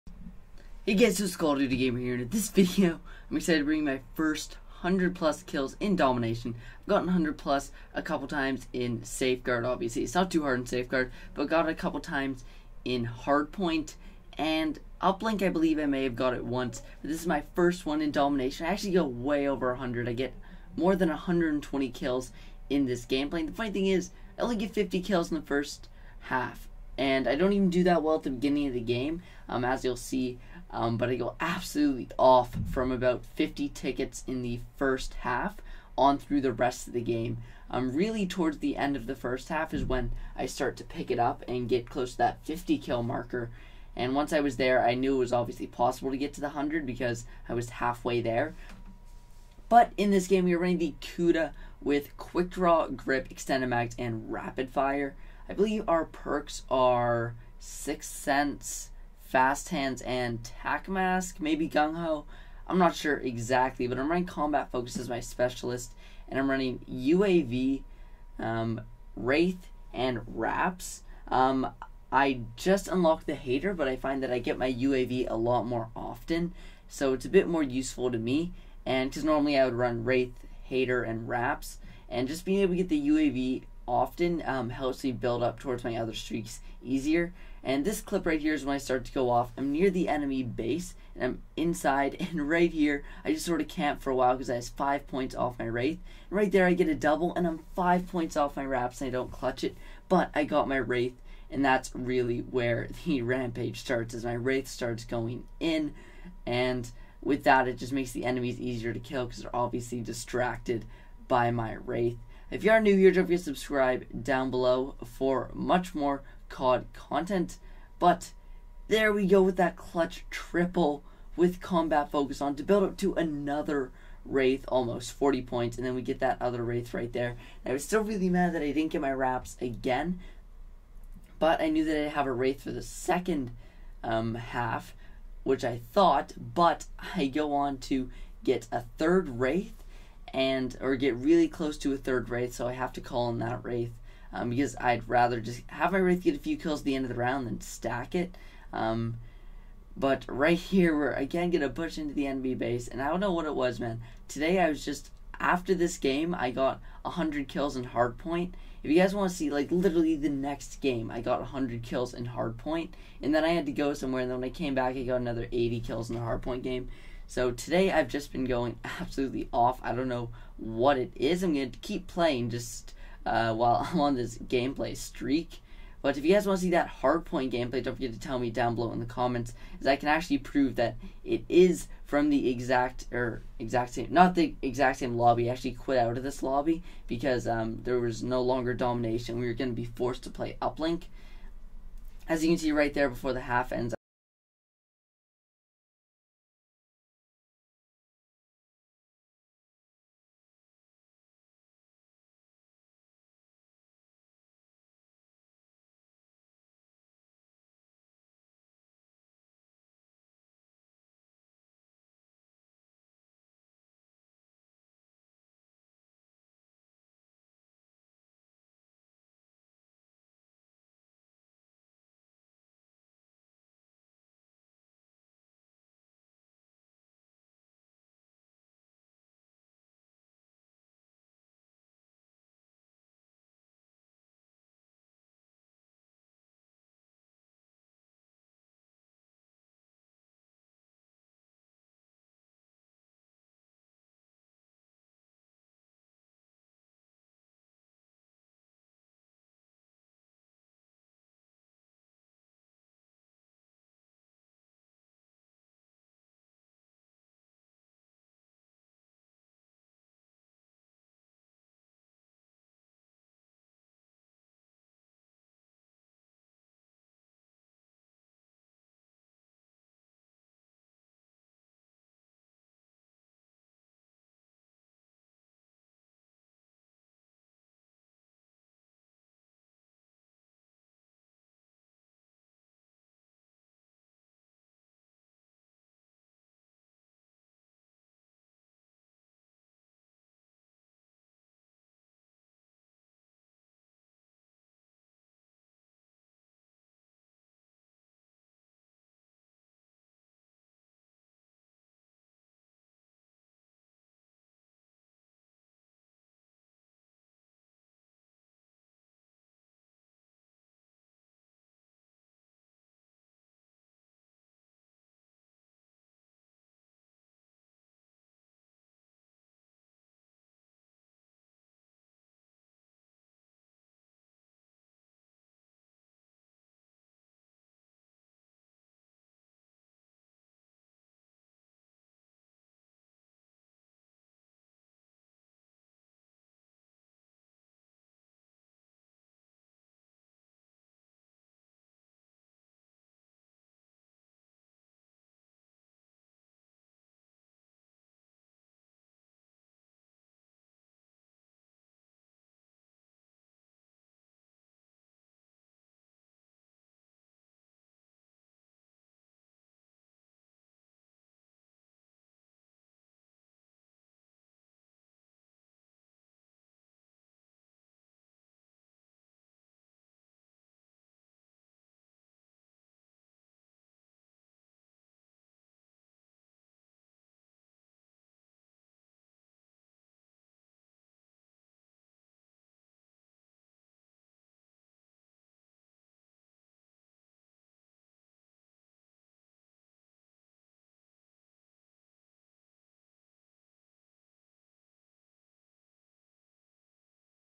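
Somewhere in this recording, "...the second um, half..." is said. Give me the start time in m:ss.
2:12.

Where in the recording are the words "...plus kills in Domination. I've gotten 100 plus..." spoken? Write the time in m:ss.
0:05.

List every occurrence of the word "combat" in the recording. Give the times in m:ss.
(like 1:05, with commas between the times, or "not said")
1:04, 2:01.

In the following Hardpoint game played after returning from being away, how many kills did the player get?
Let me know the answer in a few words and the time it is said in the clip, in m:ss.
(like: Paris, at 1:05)
80, at 2:45.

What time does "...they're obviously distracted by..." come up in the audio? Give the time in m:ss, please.
1:49.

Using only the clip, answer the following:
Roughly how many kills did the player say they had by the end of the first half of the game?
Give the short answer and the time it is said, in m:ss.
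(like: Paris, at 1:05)
50, at 0:24.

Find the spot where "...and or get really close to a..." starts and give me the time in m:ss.
2:20.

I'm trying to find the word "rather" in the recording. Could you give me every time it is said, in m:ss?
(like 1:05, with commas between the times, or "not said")
2:25.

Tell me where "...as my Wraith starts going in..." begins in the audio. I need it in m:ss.
1:44.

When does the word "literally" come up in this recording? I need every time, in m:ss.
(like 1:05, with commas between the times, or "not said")
2:39.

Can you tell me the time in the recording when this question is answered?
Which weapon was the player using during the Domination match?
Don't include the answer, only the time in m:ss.
0:51.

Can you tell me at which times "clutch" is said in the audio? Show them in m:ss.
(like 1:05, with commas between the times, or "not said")
1:39, 1:59.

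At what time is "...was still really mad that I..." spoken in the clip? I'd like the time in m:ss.
2:07.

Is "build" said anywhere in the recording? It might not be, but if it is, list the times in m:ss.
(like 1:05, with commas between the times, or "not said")
1:25, 2:02.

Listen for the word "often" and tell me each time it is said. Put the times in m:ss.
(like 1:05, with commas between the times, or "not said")
1:15, 1:23.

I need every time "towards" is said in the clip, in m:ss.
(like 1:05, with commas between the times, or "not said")
0:38, 1:25.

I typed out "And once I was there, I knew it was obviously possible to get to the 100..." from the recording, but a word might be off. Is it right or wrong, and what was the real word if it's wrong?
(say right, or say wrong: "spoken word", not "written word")
right.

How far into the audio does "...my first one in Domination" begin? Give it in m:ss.
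0:17.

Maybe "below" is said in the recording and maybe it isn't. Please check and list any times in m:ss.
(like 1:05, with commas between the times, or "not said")
1:54, 2:58.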